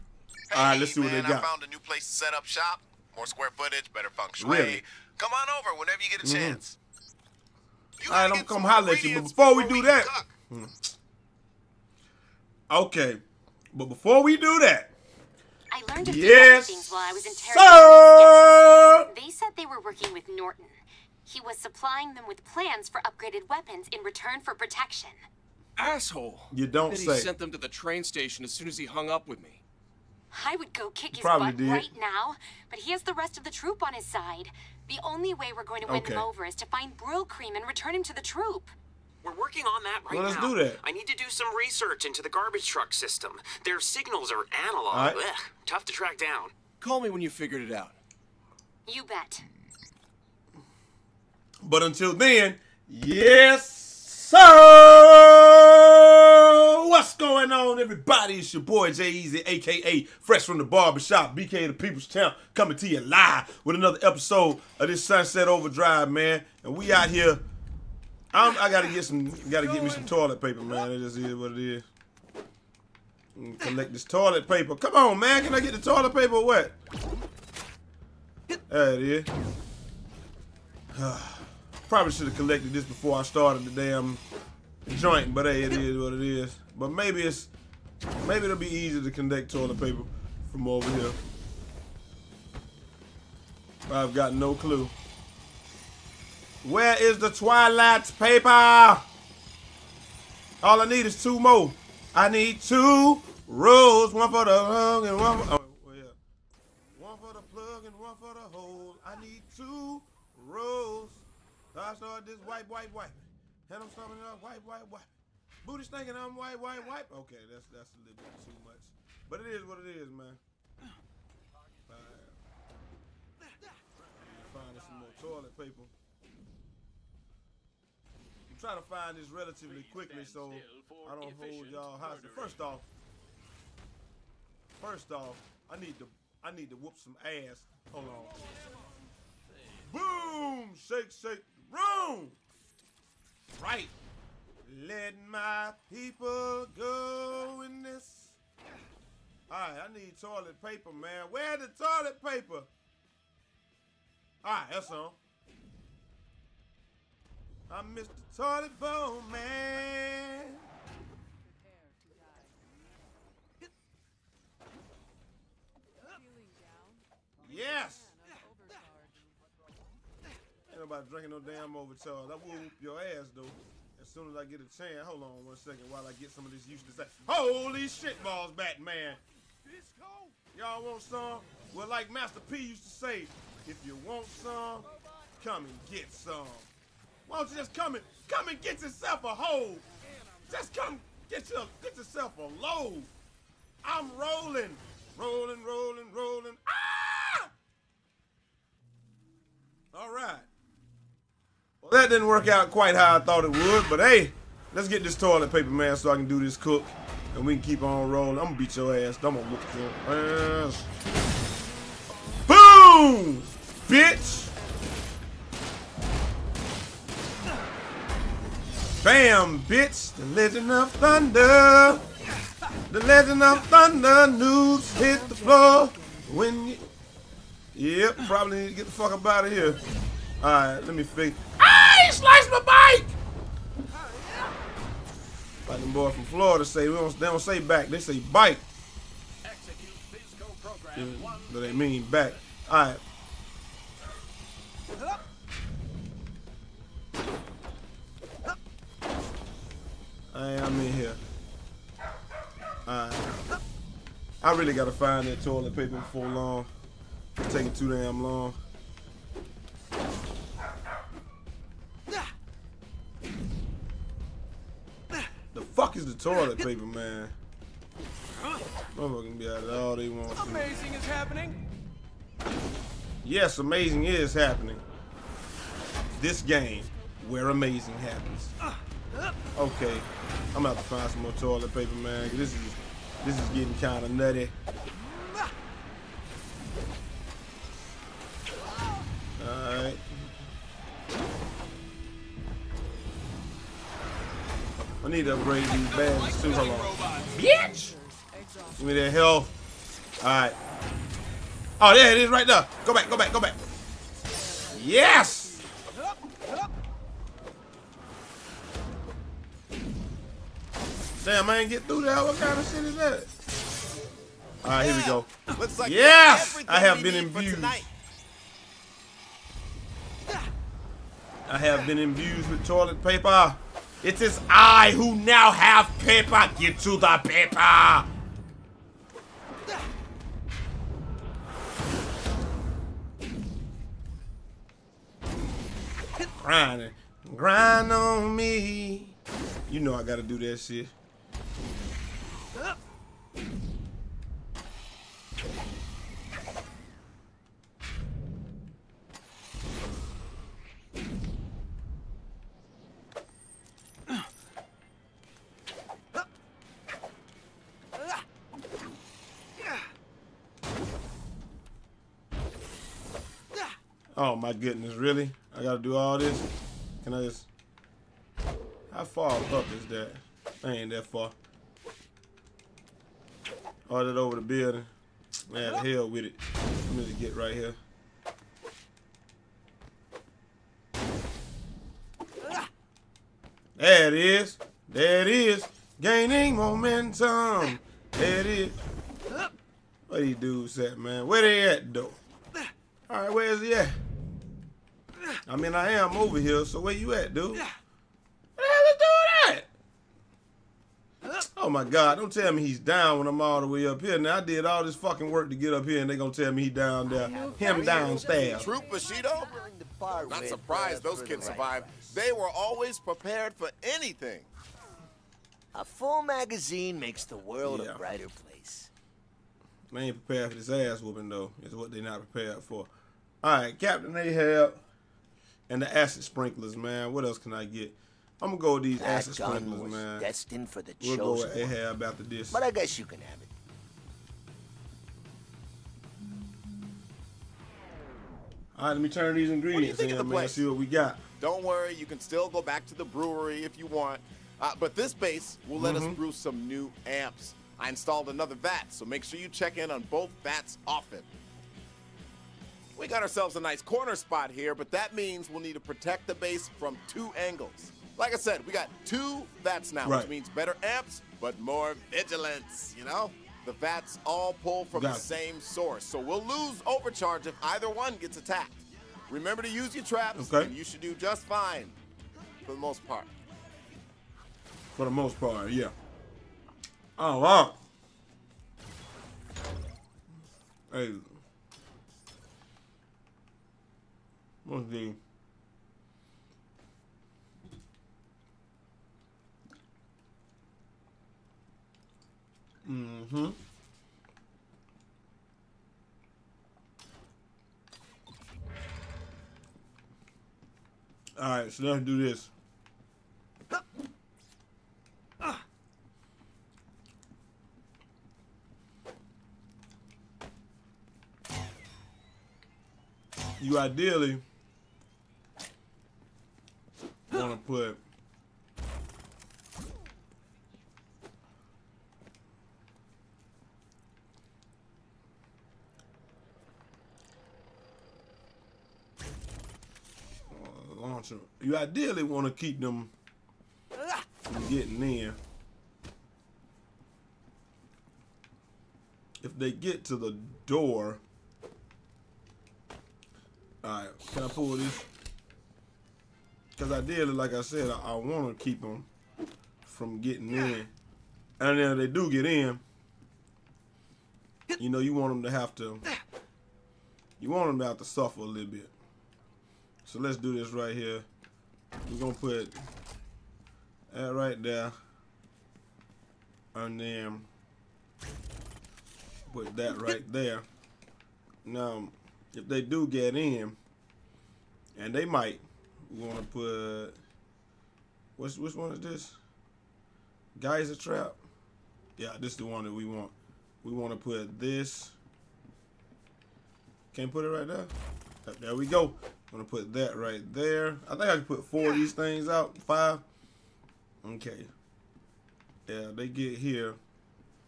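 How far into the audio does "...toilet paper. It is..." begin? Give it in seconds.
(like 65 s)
322 s.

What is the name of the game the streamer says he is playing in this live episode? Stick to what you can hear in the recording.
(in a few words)
Sunset Overdrive.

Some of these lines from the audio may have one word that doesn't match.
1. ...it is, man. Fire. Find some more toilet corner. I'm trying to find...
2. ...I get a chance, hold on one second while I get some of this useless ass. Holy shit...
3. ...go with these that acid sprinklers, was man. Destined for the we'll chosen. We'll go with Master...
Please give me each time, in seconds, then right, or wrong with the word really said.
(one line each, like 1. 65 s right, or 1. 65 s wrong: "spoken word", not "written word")
1. 119 s wrong: "paper", not "corner"
2. 174 s right
3. 428 s wrong: "Ahab", not "Master".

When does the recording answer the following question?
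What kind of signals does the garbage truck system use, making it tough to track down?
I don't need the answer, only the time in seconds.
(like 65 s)
44 s.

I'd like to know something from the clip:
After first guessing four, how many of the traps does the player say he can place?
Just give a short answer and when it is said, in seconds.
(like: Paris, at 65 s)
5, at 592 s.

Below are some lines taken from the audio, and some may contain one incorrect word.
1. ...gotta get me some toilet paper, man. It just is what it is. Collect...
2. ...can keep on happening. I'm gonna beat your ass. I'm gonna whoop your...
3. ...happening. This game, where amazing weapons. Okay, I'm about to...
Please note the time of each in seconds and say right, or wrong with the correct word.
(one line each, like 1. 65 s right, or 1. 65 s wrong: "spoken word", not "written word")
1. 69 s right
2. 207 s wrong: "rolling", not "happening"
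3. 274 s wrong: "happens", not "weapons".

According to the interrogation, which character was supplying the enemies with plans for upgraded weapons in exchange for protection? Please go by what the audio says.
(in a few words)
Norton.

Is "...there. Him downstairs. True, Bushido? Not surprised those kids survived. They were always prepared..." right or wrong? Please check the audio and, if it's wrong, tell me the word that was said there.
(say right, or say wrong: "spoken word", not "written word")
right.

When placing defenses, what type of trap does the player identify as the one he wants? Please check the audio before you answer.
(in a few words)
Geyser trap.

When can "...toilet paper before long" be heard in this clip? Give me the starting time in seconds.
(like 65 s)
255 s.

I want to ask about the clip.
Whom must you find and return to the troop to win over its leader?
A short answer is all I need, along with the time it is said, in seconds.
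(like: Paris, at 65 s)
Brill Cream, at 36 s.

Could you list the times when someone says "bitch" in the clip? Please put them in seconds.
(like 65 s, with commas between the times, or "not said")
213 s, 219 s, 297 s.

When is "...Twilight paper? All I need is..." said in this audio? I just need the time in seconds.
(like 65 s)
97 s.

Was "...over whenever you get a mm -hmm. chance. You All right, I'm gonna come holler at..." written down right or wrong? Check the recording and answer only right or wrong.
right.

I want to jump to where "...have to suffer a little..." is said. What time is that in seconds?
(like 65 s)
557 s.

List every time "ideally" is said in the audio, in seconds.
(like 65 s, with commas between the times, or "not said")
513 s, 531 s, 546 s.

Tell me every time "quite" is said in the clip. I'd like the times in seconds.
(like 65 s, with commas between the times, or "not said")
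202 s.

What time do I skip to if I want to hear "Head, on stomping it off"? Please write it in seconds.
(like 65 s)
113 s.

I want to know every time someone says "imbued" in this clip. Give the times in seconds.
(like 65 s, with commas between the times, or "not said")
317 s, 321 s.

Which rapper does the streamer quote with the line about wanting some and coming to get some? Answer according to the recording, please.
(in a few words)
Master P.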